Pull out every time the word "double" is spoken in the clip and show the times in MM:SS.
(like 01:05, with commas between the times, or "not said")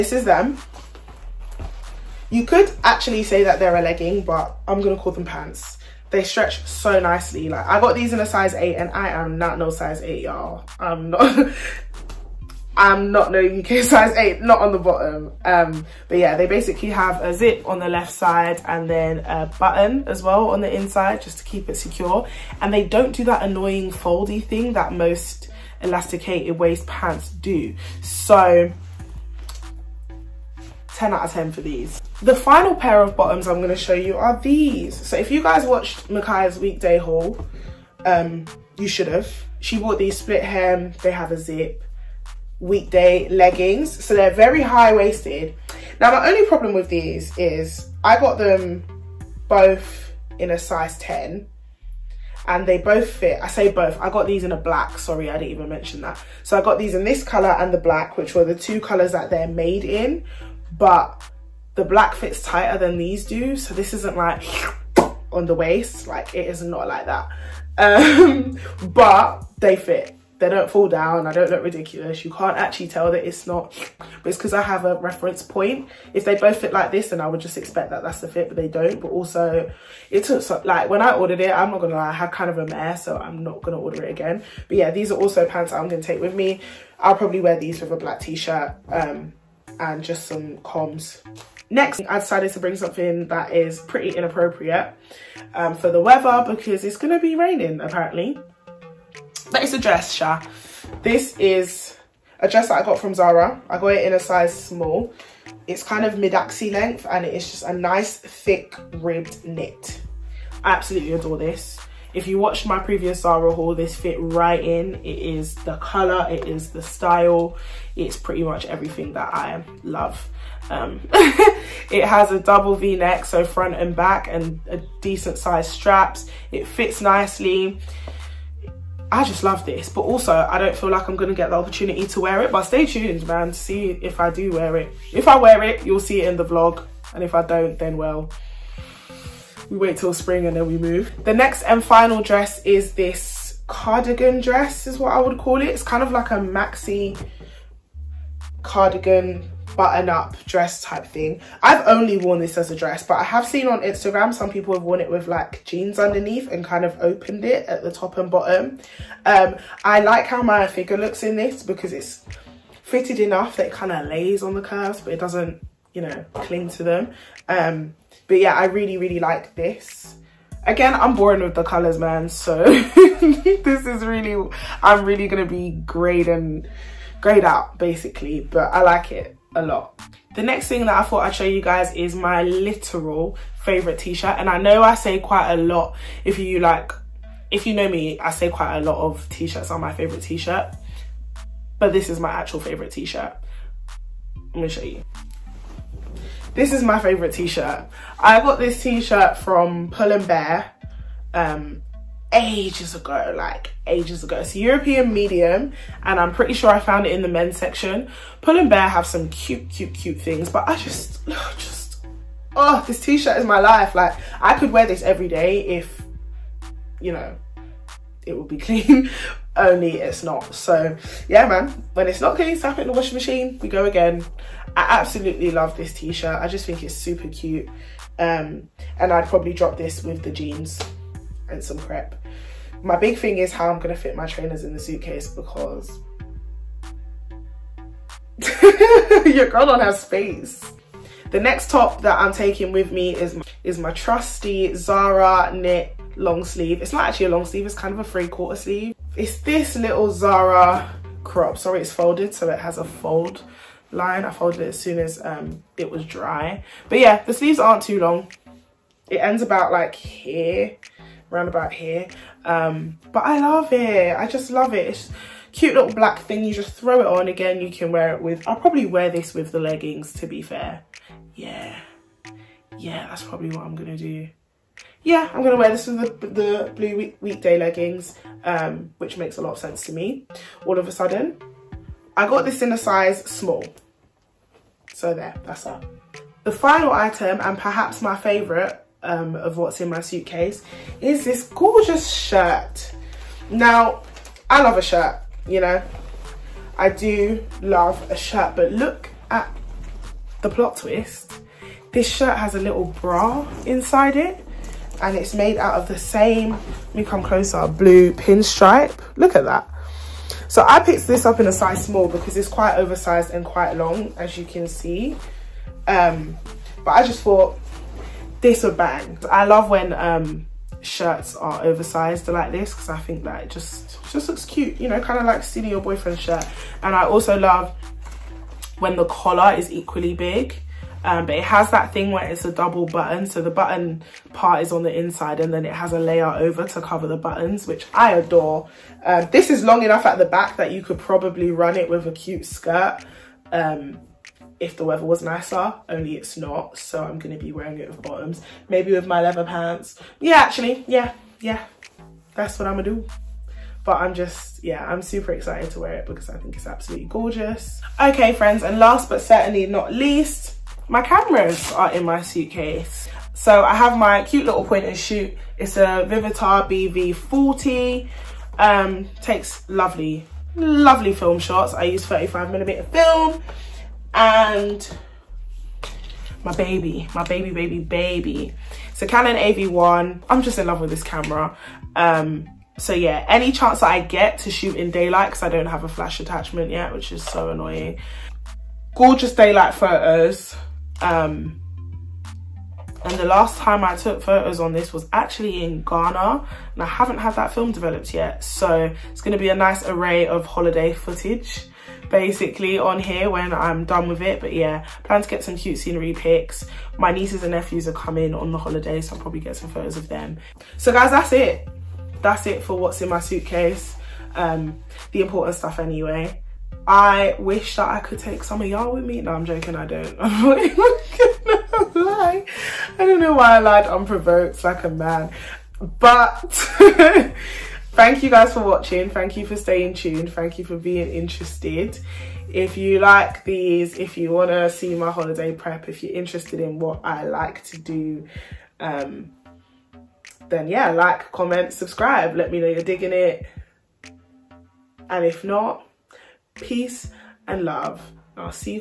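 02:02, 05:32.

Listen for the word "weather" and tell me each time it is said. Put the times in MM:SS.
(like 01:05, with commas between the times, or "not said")
01:36, 05:44.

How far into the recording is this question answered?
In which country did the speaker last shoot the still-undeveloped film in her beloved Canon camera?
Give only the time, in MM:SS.
06:35.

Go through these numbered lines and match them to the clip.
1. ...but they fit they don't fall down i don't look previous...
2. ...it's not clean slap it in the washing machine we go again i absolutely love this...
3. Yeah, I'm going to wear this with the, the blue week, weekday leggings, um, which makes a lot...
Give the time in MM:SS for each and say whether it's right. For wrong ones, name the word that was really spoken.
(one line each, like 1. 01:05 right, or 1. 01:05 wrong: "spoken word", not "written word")
1. 01:08 wrong: "ridiculous", not "previous"
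2. 03:42 right
3. 04:35 right.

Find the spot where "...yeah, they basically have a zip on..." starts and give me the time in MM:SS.
00:16.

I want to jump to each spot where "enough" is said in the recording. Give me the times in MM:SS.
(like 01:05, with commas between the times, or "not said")
02:43, 05:39.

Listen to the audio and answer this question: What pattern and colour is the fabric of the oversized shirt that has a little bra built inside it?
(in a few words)
Blue pinstripe.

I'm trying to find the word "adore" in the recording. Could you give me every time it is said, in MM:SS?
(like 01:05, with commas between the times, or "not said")
01:51, 05:38.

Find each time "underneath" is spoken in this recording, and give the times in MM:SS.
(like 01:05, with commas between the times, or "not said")
02:35.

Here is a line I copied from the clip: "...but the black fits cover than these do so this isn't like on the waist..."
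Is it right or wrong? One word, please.
wrong.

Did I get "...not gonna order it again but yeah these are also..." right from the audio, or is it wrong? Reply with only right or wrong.
right.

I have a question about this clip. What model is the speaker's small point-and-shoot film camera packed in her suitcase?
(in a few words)
Vivitar BV40.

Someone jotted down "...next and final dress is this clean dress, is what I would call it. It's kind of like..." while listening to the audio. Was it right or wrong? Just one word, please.
wrong.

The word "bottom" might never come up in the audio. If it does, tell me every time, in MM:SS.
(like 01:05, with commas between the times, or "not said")
00:14, 00:33, 02:38, 05:47.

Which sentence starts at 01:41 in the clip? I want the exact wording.
This is a dress that I got from Zara.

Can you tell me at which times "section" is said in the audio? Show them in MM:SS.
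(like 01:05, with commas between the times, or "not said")
03:27.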